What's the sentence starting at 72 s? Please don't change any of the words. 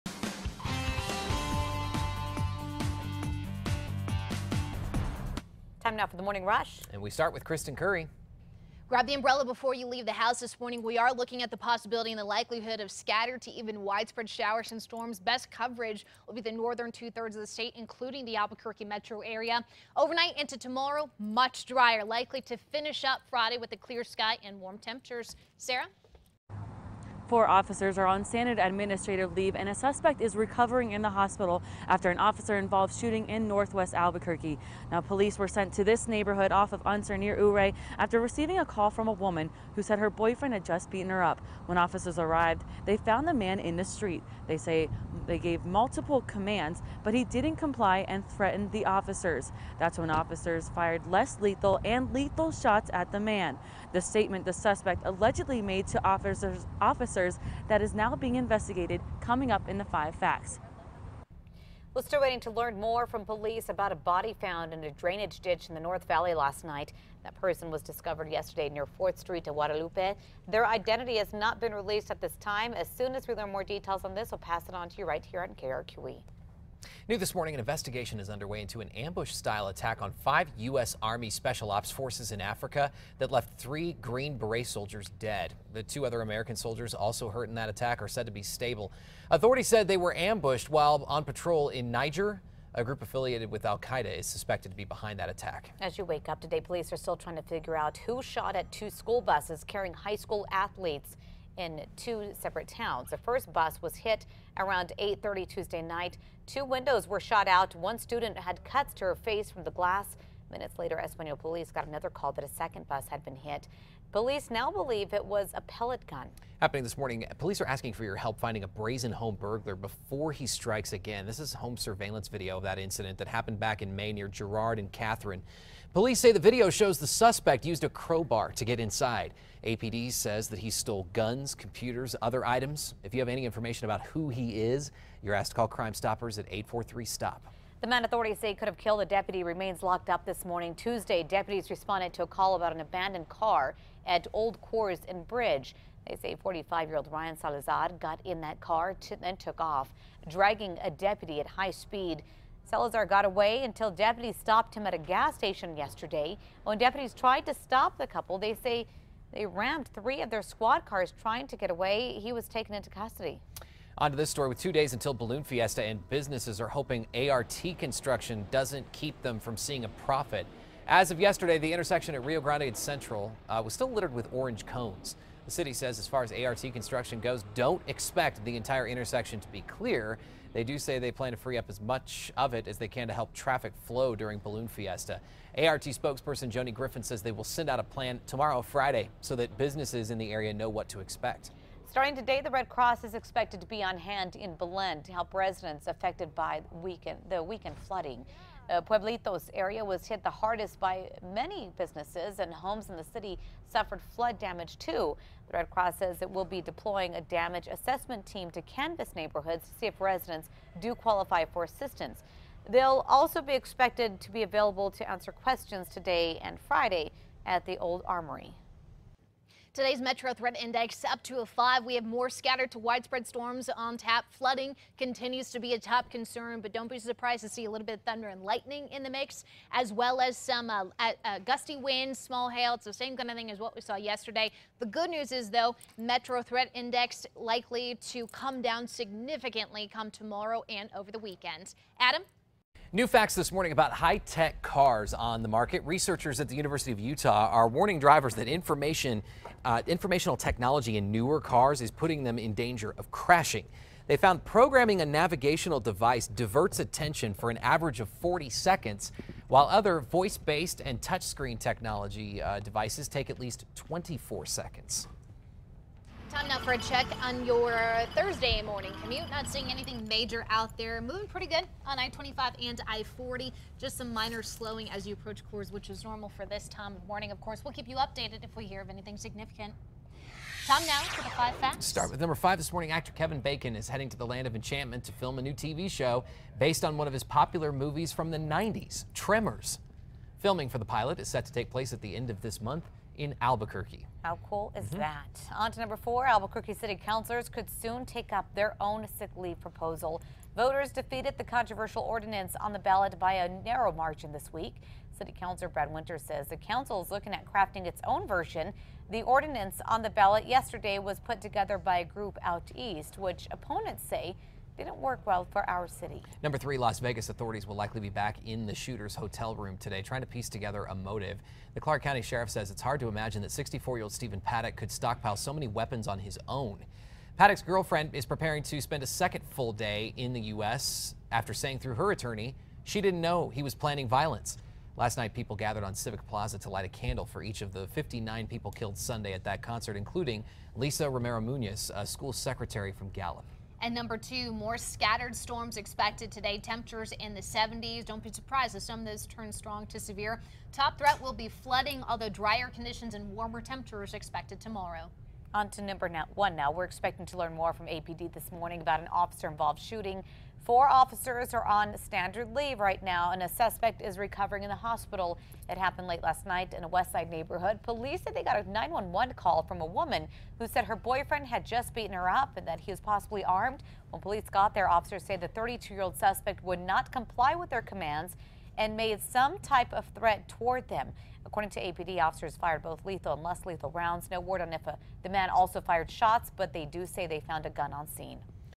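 As soon as we learn more details on this, we'll pass it on to you right here on KRQE.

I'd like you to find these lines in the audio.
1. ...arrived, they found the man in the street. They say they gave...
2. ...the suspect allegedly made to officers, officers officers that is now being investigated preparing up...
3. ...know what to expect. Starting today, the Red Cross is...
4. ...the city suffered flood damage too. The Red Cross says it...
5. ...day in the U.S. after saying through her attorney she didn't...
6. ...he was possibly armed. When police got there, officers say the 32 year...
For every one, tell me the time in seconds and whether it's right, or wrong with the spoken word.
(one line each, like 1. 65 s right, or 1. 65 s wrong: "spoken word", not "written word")
1. 42 s right
2. 54 s wrong: "coming", not "preparing"
3. 190 s right
4. 202 s right
5. 329 s right
6. 372 s right.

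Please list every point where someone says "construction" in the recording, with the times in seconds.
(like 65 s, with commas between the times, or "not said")
167 s, 176 s.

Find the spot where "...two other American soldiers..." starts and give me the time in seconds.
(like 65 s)
85 s.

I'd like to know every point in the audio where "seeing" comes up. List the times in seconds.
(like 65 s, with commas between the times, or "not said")
169 s, 269 s.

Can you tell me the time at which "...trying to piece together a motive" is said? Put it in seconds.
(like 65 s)
320 s.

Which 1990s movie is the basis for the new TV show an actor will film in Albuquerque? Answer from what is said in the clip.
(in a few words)
Tremors.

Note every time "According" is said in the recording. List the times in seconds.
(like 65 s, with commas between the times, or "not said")
381 s.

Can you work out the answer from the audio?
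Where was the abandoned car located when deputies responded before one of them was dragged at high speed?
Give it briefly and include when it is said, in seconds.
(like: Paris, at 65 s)
Old Coors and Bridge, at 144 s.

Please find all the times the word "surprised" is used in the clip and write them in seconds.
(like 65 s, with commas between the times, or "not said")
226 s, 348 s.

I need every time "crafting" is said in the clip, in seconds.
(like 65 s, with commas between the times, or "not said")
307 s.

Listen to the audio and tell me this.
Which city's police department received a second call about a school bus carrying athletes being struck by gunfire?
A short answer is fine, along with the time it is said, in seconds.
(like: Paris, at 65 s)
Española, at 111 s.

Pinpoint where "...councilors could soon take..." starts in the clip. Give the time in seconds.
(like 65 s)
297 s.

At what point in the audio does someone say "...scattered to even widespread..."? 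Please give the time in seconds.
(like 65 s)
12 s.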